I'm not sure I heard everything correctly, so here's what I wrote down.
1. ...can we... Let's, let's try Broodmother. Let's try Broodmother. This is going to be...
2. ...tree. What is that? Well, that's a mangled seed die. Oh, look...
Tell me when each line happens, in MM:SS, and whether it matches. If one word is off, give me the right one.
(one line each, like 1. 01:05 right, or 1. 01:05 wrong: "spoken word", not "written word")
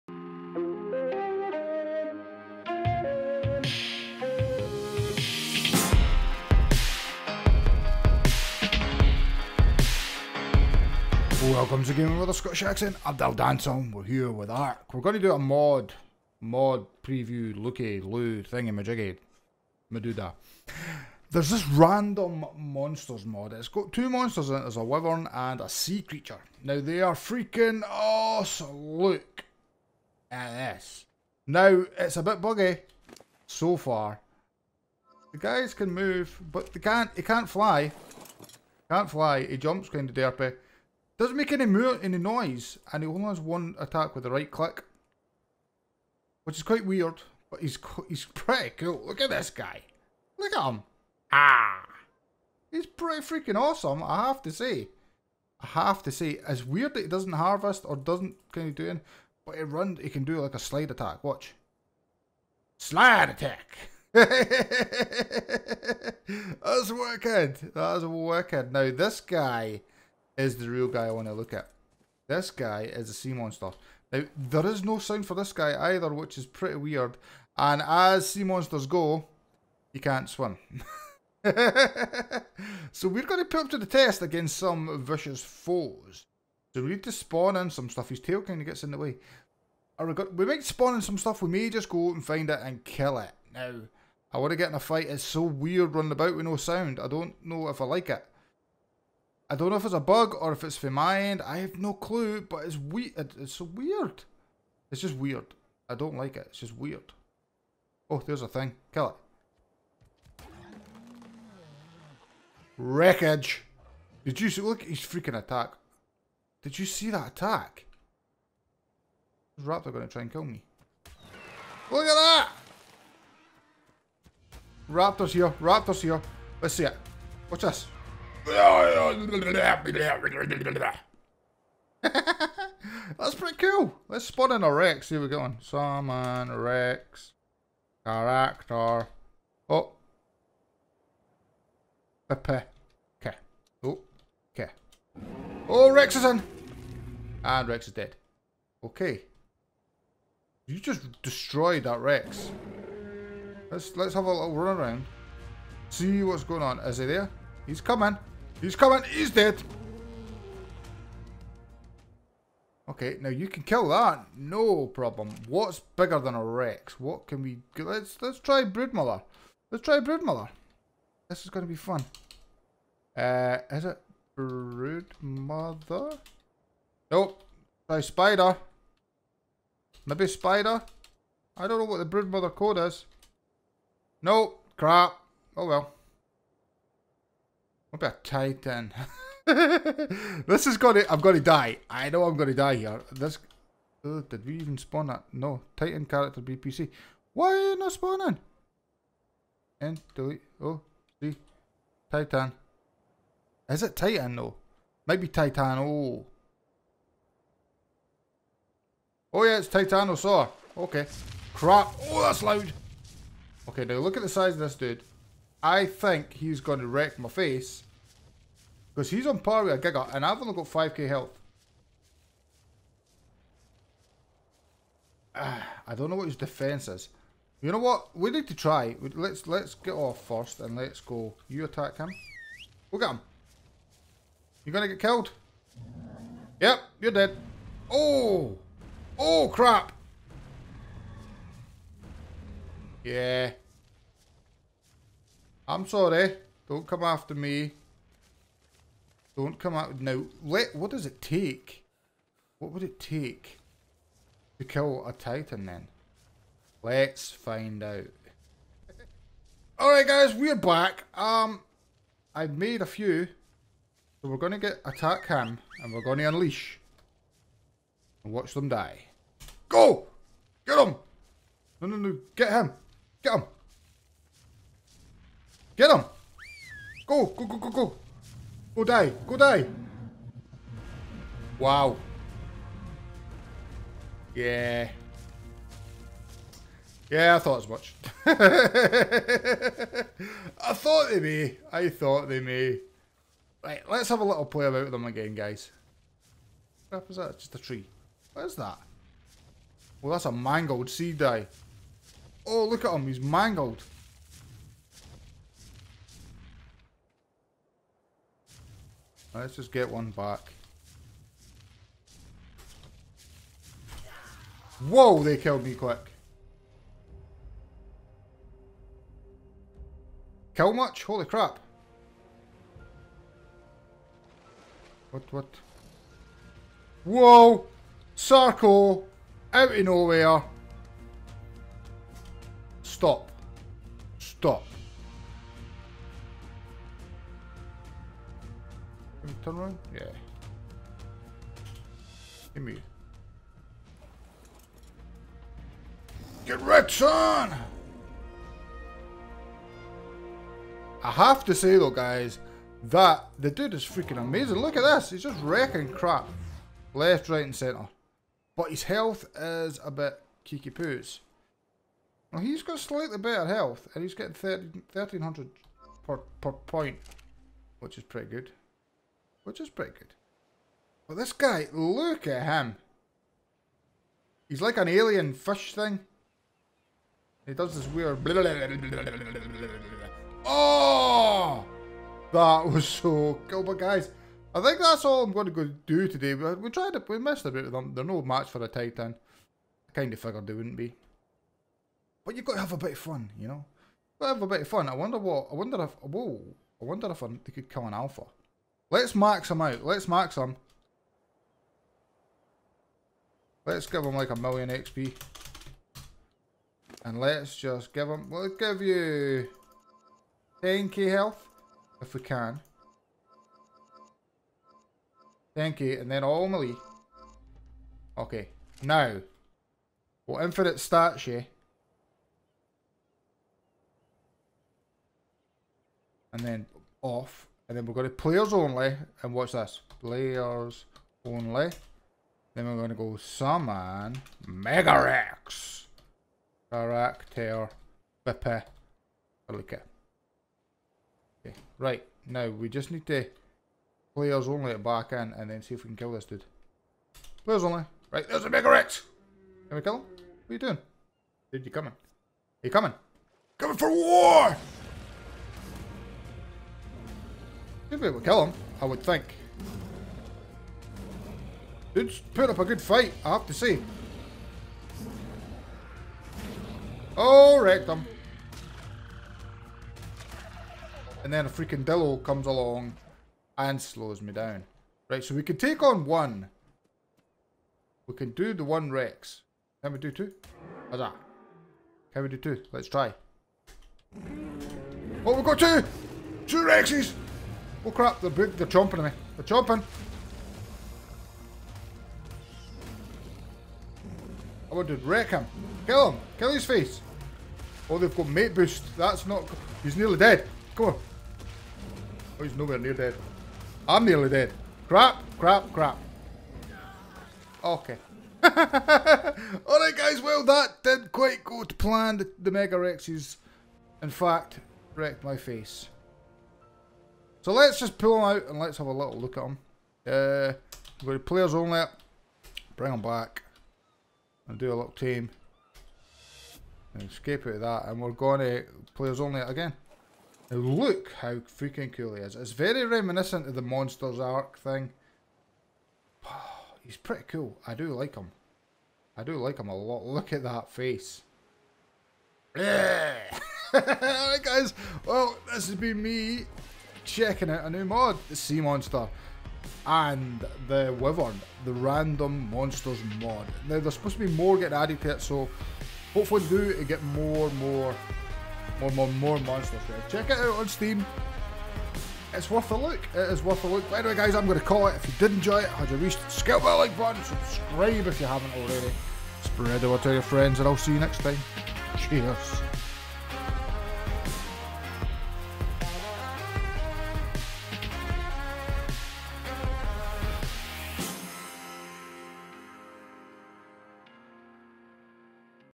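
1. 02:47 right
2. 04:57 right.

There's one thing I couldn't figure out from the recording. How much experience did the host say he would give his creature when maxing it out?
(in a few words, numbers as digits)
a million XP.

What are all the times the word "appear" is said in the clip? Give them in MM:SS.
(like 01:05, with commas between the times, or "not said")
not said.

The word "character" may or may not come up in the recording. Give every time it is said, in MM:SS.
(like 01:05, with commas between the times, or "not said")
02:18, 03:16, 07:16.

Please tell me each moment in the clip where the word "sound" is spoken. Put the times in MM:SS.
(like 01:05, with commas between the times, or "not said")
01:14, 01:36.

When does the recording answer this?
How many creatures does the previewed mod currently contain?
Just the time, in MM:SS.
00:23.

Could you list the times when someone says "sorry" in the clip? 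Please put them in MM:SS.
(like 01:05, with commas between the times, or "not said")
04:05.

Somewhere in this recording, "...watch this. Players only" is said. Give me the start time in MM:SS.
07:09.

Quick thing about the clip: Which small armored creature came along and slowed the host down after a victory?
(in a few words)
Dillo.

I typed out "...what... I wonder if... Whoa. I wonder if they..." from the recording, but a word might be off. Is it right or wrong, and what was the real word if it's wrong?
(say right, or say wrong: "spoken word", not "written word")
right.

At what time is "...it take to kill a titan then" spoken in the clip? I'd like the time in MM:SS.
04:12.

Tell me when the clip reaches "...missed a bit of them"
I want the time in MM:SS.
06:27.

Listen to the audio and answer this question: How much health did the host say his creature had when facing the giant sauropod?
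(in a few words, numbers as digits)
5k.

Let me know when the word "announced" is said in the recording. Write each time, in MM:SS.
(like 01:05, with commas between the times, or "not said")
not said.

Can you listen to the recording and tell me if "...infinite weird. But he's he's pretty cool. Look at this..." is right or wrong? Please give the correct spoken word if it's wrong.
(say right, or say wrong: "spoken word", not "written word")
wrong: "quite", not "infinite".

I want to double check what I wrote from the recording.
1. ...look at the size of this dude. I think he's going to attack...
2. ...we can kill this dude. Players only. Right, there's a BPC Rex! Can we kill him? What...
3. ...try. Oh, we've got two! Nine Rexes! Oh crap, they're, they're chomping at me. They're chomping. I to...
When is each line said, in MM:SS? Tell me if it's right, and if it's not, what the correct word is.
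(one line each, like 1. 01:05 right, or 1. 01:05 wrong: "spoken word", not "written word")
1. 03:33 wrong: "wreck", not "attack"
2. 07:25 wrong: "Mega", not "BPC"
3. 08:02 wrong: "Two", not "Nine".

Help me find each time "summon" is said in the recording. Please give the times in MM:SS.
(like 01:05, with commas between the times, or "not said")
02:15, 07:13.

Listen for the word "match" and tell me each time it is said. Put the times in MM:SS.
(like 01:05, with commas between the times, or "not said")
06:28.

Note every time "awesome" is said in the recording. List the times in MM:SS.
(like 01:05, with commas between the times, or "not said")
00:27, 00:53.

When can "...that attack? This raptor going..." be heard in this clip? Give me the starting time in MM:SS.
01:57.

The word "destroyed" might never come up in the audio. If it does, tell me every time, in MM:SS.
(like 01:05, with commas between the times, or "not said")
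02:31.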